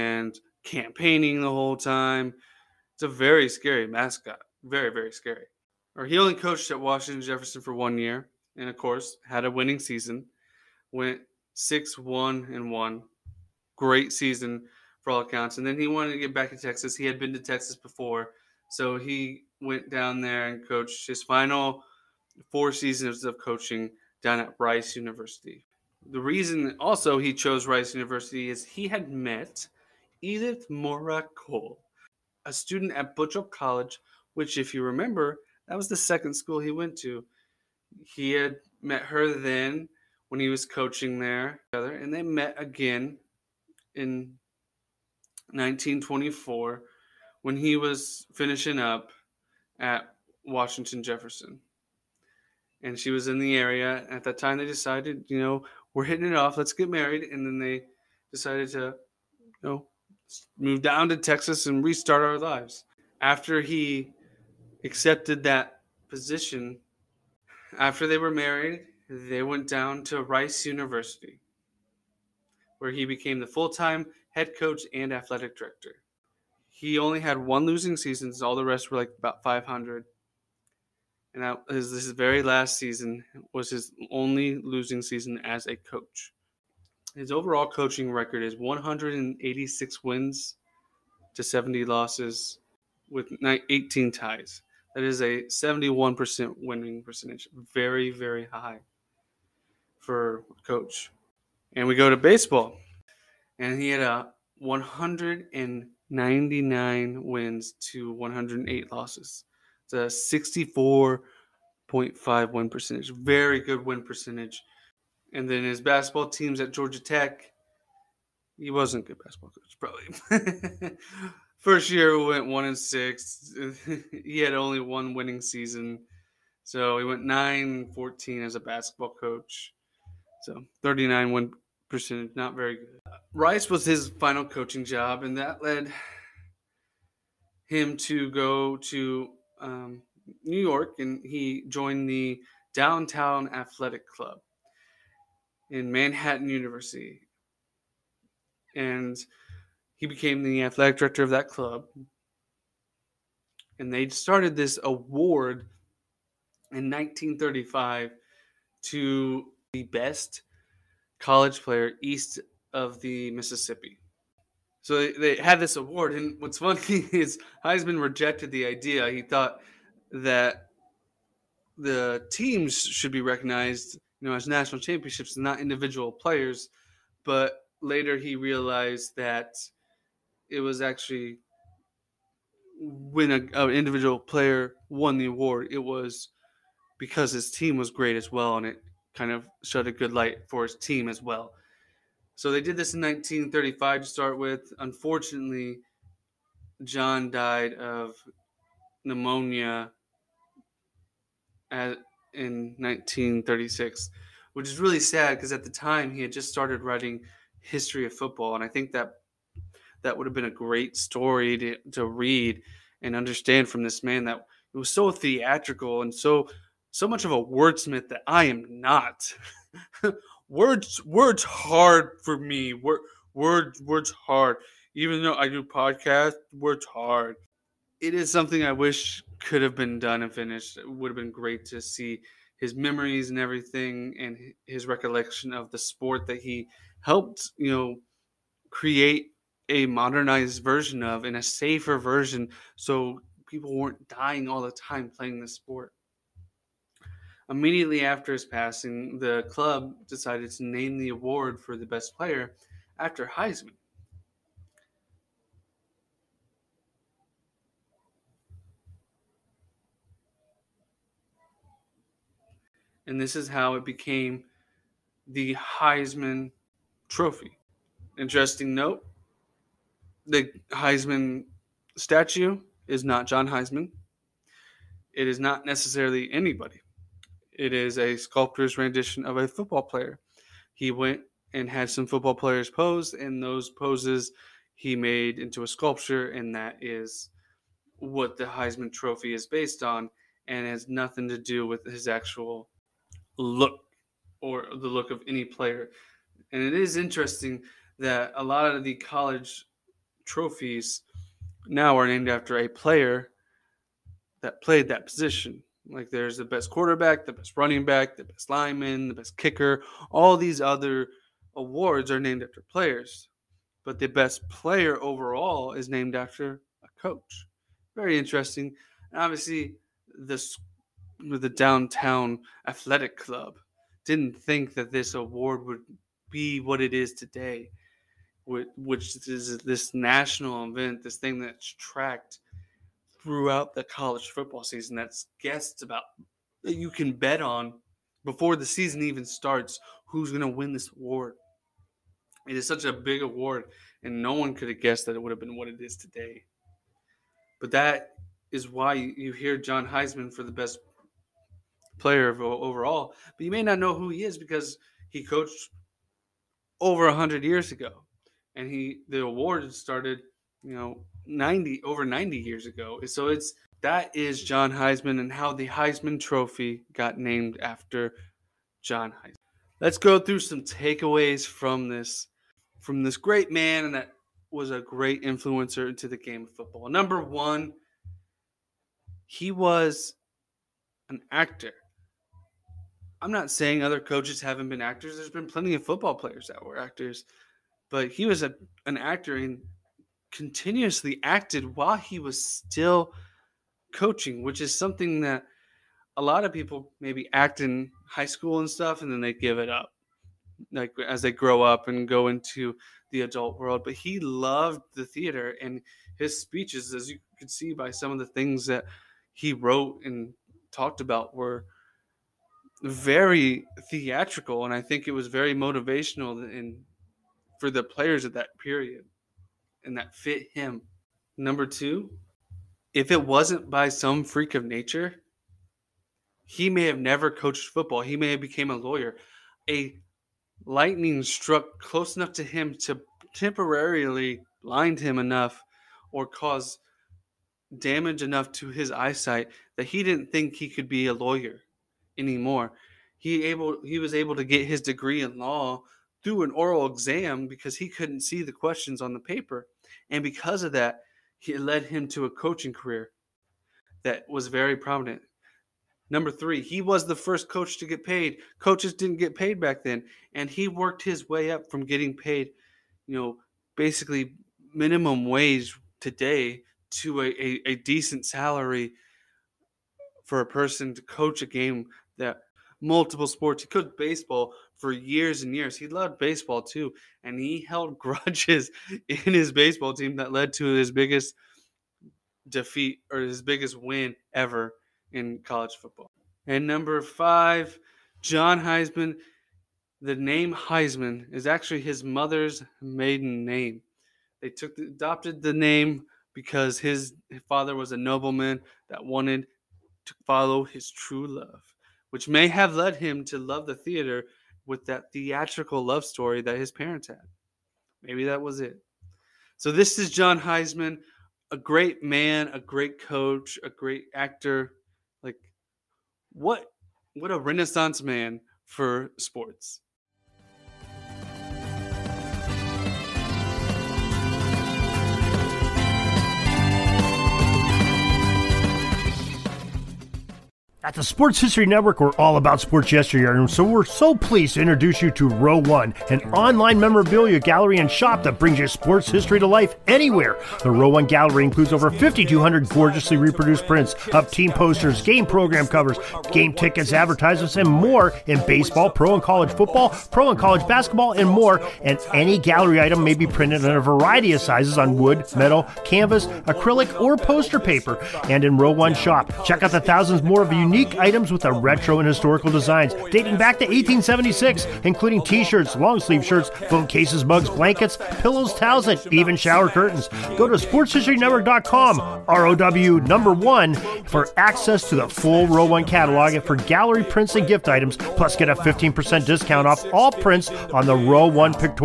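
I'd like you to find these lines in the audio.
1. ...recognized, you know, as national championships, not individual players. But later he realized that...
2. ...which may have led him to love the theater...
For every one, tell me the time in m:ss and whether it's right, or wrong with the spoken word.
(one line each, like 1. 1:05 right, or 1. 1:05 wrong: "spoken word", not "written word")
1. 2:53 right
2. 8:22 right.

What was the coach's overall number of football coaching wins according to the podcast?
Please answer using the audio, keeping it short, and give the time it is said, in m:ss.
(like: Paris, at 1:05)
186, at 1:28.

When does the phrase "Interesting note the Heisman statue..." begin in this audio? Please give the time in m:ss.
4:28.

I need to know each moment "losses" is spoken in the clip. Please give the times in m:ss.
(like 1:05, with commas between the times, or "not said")
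1:31, 1:48.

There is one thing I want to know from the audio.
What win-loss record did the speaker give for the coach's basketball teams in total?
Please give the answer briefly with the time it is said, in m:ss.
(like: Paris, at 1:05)
9-14, at 2:07.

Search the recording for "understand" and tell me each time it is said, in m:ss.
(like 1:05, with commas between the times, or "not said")
3:33.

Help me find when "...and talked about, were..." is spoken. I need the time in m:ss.
6:50.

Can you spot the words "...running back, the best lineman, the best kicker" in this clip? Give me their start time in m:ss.
5:07.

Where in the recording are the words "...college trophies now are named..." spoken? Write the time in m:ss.
4:58.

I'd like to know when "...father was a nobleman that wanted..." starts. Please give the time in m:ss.
8:17.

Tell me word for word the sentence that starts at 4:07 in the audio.
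Immediately after his passing, the club decided to name the award for the best player after Heisman.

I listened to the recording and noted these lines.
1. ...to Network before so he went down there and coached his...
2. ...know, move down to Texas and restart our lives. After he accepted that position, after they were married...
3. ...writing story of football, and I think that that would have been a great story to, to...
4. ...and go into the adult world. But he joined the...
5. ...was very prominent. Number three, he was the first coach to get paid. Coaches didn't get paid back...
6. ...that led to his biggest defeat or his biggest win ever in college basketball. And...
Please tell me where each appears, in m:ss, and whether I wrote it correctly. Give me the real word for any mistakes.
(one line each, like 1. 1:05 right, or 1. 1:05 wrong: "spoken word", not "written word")
1. 0:17 wrong: "Texas", not "Network"
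2. 0:59 right
3. 3:26 wrong: "history", not "story"
4. 6:41 wrong: "loved", not "joined"
5. 7:34 right
6. 8:00 wrong: "football", not "basketball".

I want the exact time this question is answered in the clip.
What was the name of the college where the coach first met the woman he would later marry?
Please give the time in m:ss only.
0:33.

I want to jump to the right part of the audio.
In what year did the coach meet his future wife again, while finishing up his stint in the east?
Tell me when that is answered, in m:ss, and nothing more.
0:45.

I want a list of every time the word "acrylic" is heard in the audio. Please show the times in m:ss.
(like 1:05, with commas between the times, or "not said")
9:16.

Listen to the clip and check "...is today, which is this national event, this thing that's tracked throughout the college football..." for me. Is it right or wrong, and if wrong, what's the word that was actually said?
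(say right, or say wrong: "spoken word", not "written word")
right.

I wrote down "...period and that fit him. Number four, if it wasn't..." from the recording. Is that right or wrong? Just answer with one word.
wrong.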